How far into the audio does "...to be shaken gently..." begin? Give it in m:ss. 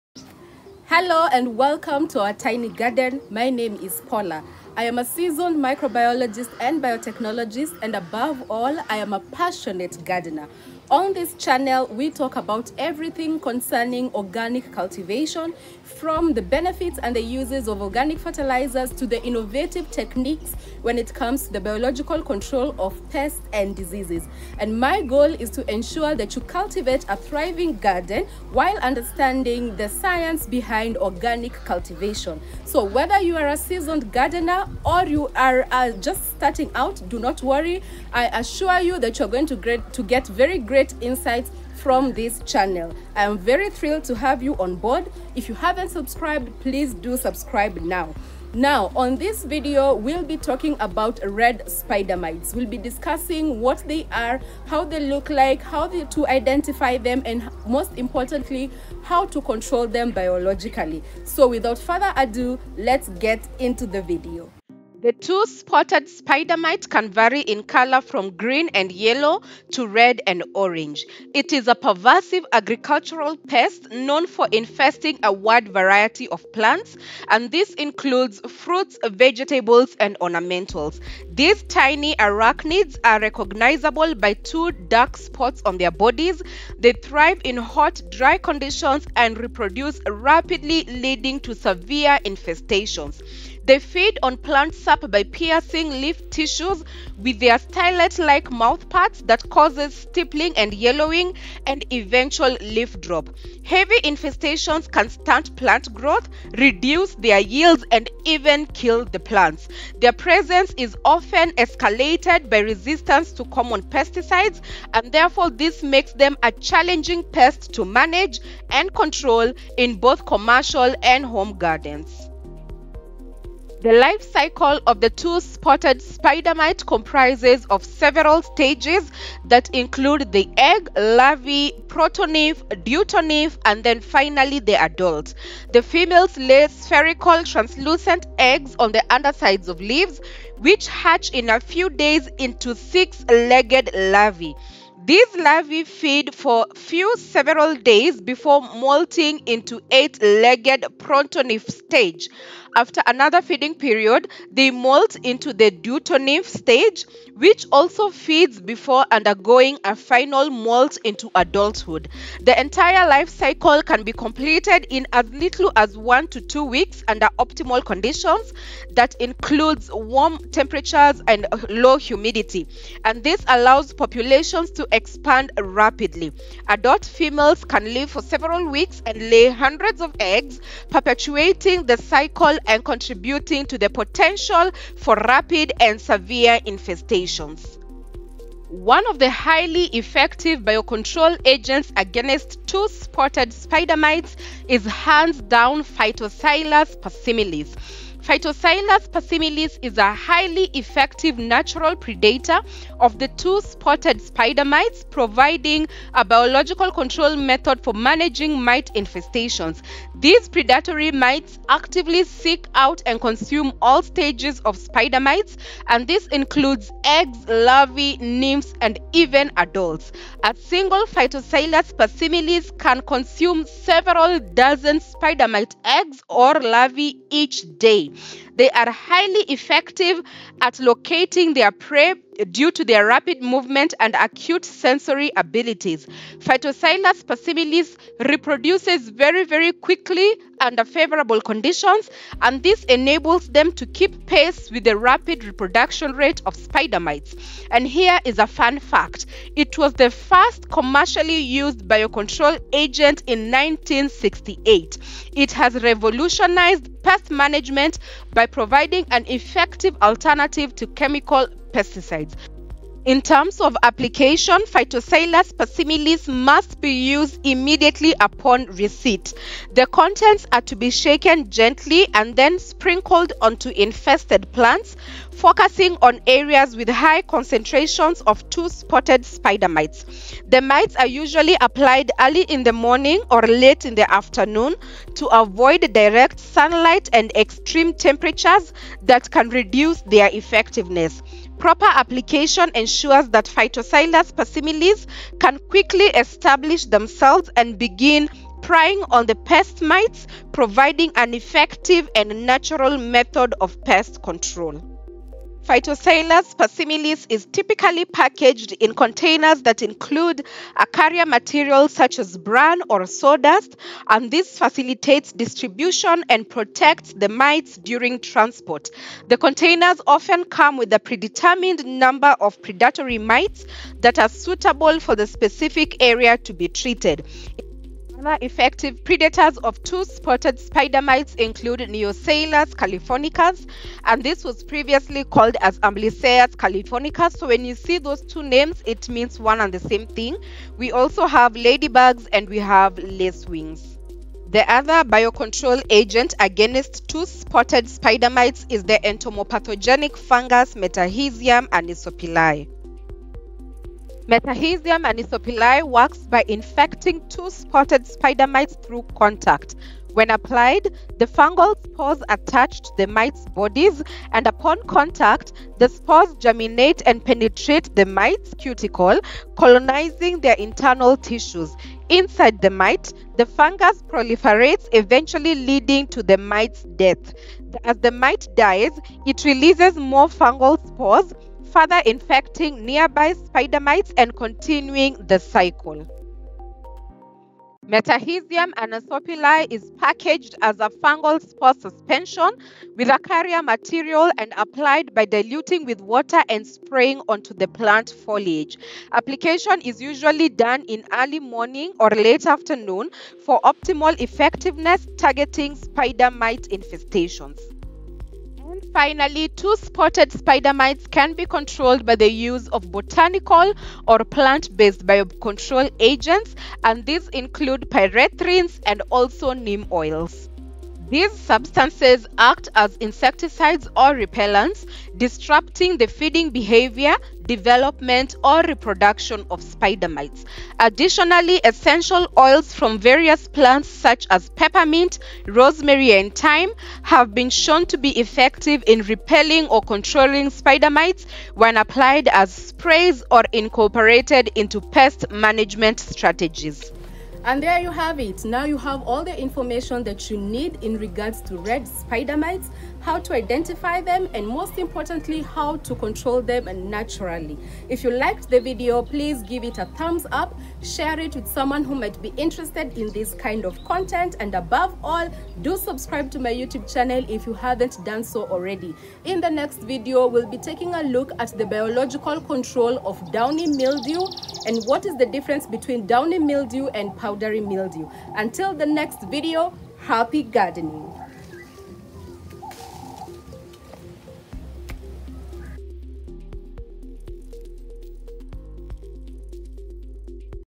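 4:30.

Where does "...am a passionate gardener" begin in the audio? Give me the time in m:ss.
0:08.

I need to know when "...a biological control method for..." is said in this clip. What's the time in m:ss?
3:26.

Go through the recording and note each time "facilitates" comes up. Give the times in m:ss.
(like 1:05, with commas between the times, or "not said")
5:14.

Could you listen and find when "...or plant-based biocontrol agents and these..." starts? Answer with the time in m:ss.
6:54.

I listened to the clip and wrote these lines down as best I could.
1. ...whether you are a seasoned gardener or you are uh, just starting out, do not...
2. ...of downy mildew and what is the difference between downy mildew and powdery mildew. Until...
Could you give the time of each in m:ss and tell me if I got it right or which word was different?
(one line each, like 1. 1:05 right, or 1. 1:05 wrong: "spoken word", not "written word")
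1. 0:32 right
2. 7:53 right.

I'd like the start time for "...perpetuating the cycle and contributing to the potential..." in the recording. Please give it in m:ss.
3:00.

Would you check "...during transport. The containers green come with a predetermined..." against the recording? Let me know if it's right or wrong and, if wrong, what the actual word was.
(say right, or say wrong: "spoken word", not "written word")
wrong: "often", not "green".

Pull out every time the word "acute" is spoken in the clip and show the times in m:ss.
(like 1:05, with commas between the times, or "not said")
3:54.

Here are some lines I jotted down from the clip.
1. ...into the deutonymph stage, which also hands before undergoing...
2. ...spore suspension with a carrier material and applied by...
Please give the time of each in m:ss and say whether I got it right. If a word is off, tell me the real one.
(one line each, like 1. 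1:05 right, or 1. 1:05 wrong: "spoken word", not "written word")
1. 2:35 wrong: "feeds", not "hands"
2. 6:31 right.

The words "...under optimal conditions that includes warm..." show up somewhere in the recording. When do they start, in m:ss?
2:47.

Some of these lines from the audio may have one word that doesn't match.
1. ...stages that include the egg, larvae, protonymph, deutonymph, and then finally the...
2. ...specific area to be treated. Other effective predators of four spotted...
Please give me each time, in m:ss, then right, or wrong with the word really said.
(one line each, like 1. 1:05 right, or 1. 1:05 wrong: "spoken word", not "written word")
1. 2:08 right
2. 5:25 wrong: "two", not "four".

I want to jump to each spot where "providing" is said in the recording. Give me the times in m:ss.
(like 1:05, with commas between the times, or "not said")
3:25, 4:18, 5:00.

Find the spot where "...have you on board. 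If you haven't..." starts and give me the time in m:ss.
0:44.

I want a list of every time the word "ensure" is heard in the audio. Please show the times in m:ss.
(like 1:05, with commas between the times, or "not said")
0:25, 4:52.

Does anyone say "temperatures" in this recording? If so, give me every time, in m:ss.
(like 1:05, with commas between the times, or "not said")
2:50, 4:47.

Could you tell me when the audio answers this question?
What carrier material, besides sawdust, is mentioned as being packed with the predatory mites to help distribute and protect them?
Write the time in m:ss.
5:12.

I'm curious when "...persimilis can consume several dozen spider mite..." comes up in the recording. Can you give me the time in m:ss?
3:41.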